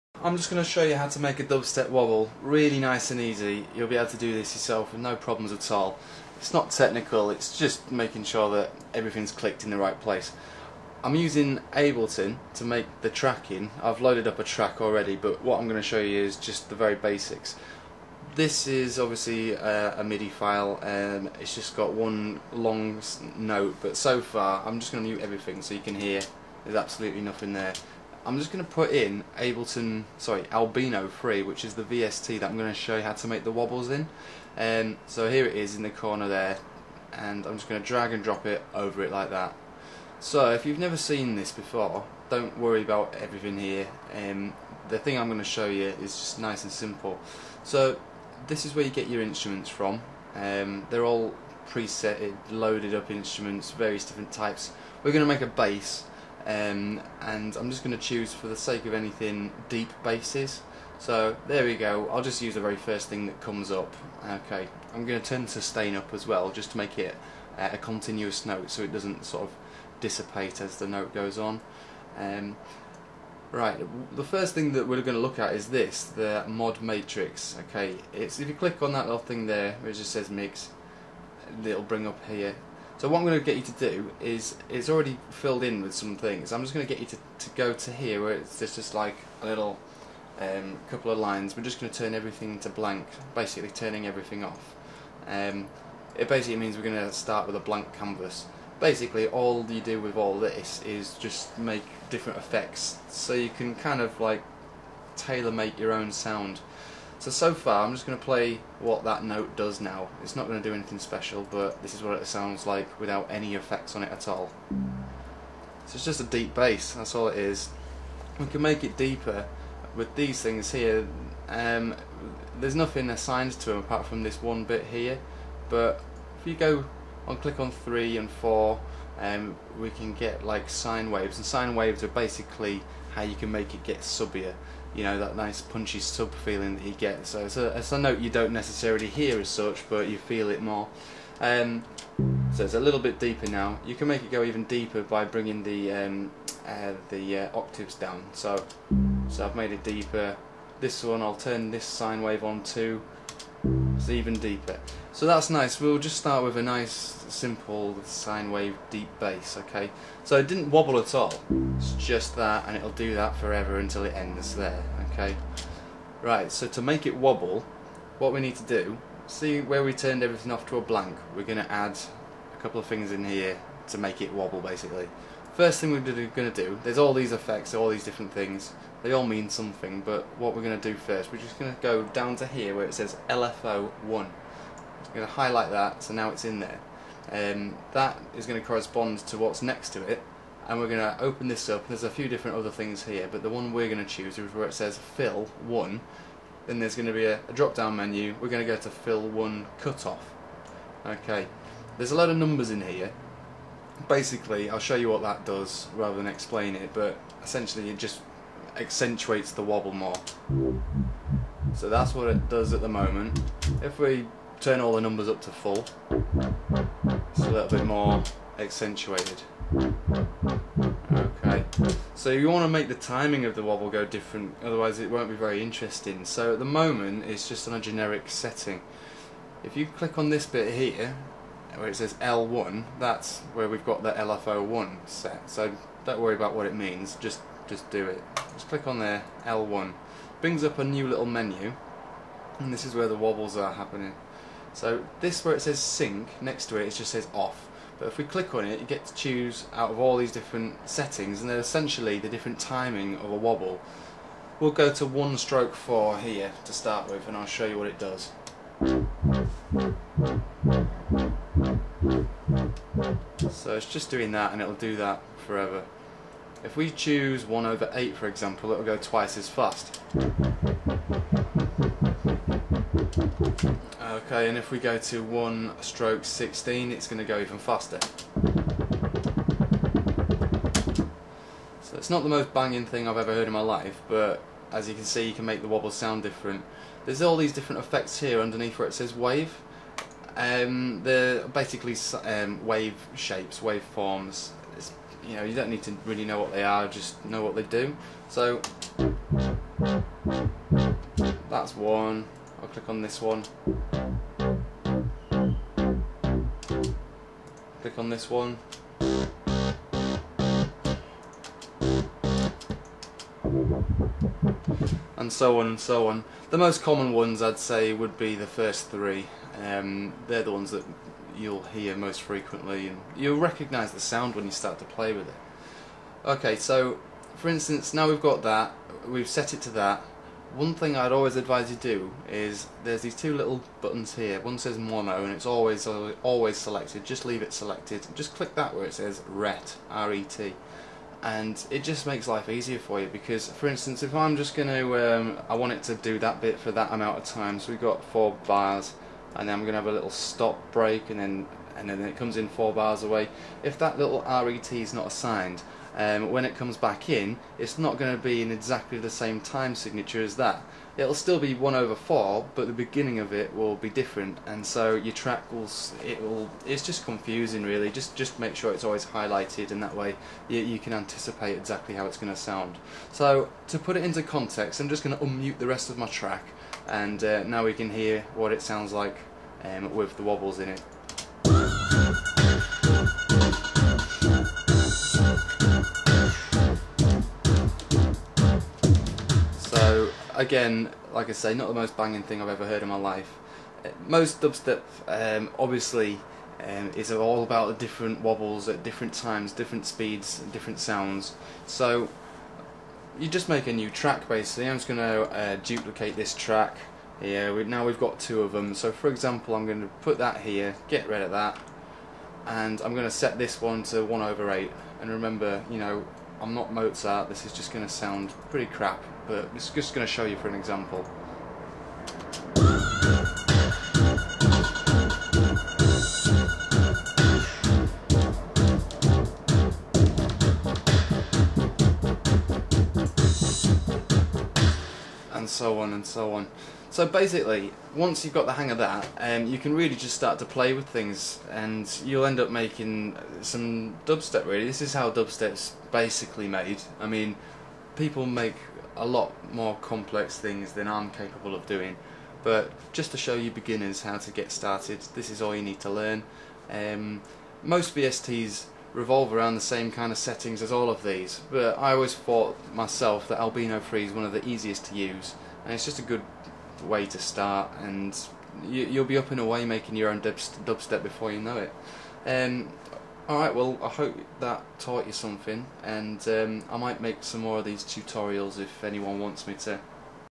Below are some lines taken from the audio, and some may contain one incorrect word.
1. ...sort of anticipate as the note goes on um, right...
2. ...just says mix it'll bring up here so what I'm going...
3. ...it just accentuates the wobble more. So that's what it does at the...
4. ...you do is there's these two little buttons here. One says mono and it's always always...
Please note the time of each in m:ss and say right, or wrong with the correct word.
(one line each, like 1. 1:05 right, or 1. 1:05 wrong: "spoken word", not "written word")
1. 1:09 wrong: "dissipate", not "anticipate"
2. 1:19 right
3. 3:27 right
4. 5:31 right.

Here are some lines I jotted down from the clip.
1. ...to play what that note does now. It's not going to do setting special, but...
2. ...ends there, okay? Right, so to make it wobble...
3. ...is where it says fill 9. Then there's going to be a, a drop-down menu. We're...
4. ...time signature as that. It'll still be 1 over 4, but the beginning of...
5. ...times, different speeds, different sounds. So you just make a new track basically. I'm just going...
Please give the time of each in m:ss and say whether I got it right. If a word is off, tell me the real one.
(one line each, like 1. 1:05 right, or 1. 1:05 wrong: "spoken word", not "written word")
1. 1:48 wrong: "anything", not "setting"
2. 2:44 right
3. 3:14 wrong: "1", not "9"
4. 5:59 right
5. 6:39 right.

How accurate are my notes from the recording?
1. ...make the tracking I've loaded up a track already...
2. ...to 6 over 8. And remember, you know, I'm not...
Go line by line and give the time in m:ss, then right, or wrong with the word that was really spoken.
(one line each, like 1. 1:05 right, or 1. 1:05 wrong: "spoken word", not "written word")
1. 0:12 right
2. 6:53 wrong: "1", not "6".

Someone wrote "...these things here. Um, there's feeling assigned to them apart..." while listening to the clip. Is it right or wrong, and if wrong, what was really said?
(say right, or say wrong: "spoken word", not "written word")
wrong: "nothing", not "feeling".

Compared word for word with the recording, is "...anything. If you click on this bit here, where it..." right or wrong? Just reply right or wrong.
wrong.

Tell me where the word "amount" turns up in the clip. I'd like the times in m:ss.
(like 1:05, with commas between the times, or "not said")
5:46.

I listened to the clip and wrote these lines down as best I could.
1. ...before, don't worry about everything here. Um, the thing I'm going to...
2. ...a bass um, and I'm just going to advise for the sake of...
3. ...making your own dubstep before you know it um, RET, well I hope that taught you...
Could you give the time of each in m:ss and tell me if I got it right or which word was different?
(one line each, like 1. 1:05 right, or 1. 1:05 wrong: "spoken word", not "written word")
1. 0:41 right
2. 0:55 wrong: "choose", not "advise"
3. 7:49 wrong: "Alright", not "RET".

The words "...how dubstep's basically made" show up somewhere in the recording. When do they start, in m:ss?
7:24.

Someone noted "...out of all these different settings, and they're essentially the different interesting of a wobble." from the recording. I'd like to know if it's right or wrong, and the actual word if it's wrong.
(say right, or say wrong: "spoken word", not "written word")
wrong: "timing", not "interesting".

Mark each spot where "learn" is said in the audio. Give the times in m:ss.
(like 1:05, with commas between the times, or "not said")
7:35.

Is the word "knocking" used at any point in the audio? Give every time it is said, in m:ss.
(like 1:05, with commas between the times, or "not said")
not said.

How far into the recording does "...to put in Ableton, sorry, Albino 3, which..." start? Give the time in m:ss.
0:28.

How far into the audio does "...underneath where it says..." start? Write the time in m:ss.
4:48.